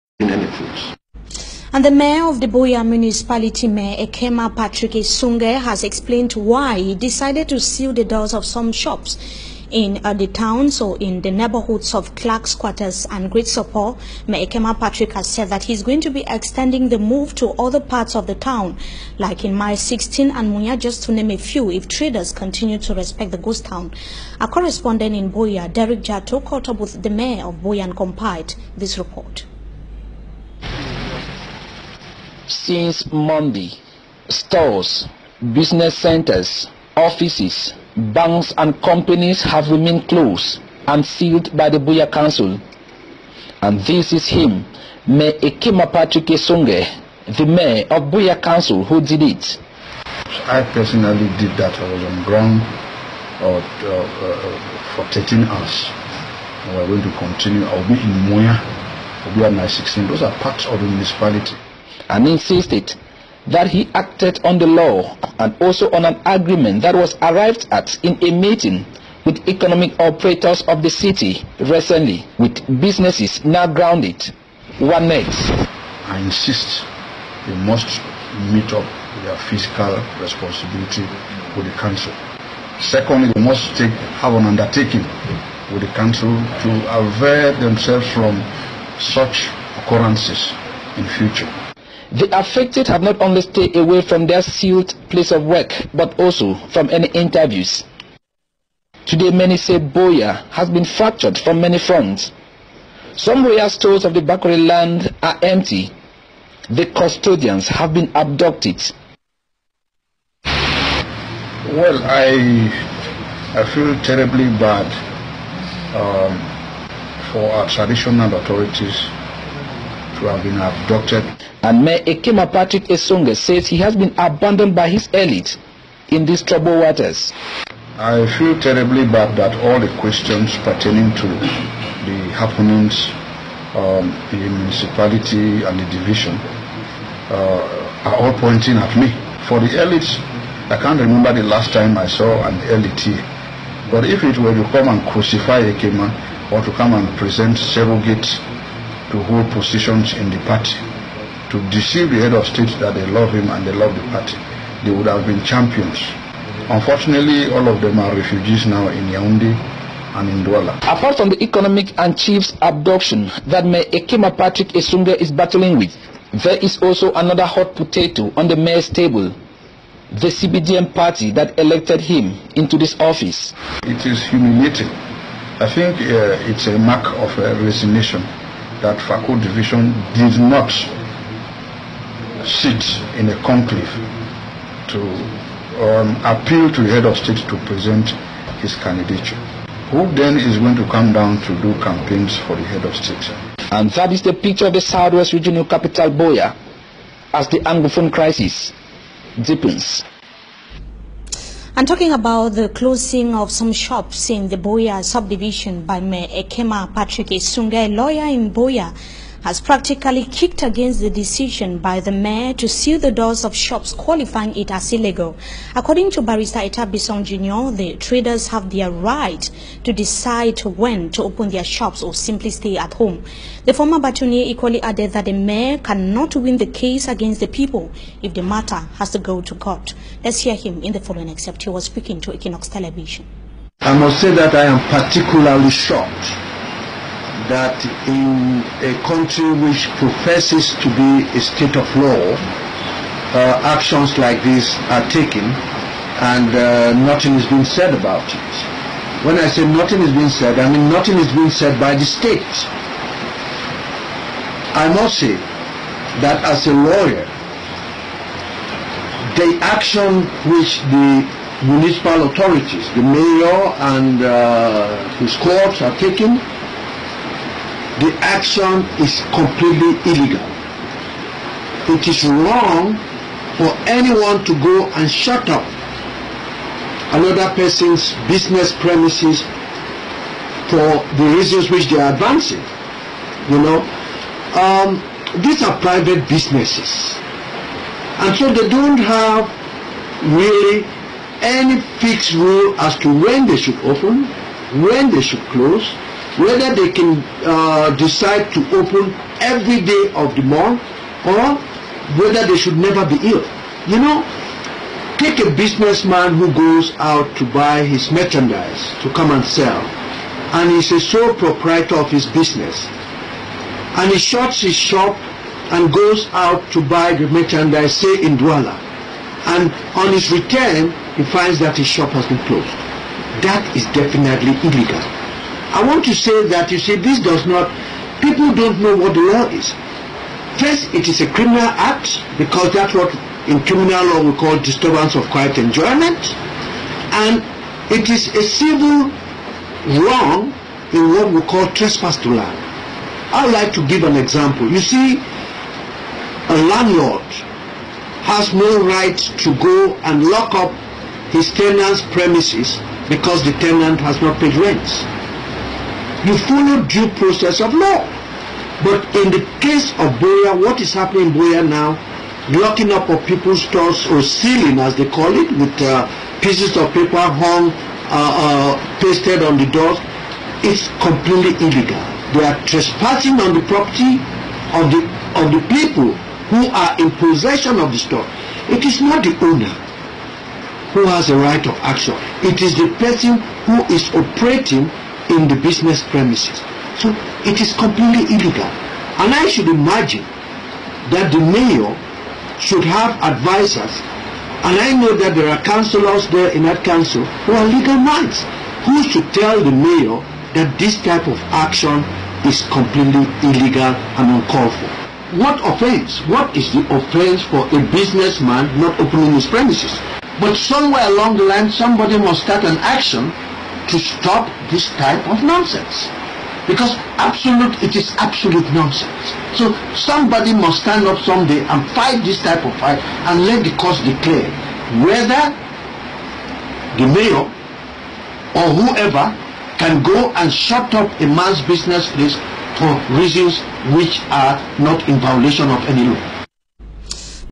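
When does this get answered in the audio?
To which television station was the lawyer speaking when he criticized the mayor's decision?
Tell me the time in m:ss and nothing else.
3:52.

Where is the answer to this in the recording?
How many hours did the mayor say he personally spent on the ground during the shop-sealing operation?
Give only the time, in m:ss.
0:55.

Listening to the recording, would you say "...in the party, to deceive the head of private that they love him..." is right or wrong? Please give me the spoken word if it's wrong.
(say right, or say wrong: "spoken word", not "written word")
wrong: "state", not "private".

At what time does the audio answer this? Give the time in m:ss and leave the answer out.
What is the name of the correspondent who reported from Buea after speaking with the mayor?
0:25.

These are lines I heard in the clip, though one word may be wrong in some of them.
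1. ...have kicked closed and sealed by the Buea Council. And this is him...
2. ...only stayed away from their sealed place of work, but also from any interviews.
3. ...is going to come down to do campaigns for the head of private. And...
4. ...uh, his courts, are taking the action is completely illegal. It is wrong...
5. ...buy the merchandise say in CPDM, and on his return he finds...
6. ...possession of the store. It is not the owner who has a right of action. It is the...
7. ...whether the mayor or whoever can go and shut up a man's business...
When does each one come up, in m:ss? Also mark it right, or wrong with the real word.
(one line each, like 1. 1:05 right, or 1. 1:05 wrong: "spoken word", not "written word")
1. 0:39 wrong: "remained", not "kicked"
2. 1:33 right
3. 3:10 wrong: "state", not "private"
4. 4:24 right
5. 5:16 wrong: "Douala", not "CPDM"
6. 6:17 right
7. 7:05 right.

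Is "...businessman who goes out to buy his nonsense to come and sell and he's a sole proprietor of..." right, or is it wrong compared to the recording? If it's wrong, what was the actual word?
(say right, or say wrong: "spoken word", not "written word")
wrong: "merchandise", not "nonsense".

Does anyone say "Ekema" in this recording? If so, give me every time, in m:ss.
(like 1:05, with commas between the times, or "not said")
0:04, 0:14, 0:45, 2:02, 2:25, 2:43, 3:26.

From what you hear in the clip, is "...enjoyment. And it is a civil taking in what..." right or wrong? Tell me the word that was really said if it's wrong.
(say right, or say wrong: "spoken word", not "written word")
wrong: "wrong", not "taking".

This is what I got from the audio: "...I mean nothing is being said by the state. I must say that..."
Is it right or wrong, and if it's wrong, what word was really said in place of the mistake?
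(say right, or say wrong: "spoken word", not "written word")
right.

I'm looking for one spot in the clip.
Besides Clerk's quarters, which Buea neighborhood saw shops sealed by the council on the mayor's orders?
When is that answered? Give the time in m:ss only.
0:13.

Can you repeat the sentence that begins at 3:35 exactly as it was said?
According to Barrister Bison Jr., the traders have their right to decide when to open their shops or simply stay at home.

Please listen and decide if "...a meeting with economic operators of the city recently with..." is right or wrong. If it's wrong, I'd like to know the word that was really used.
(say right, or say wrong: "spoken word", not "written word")
right.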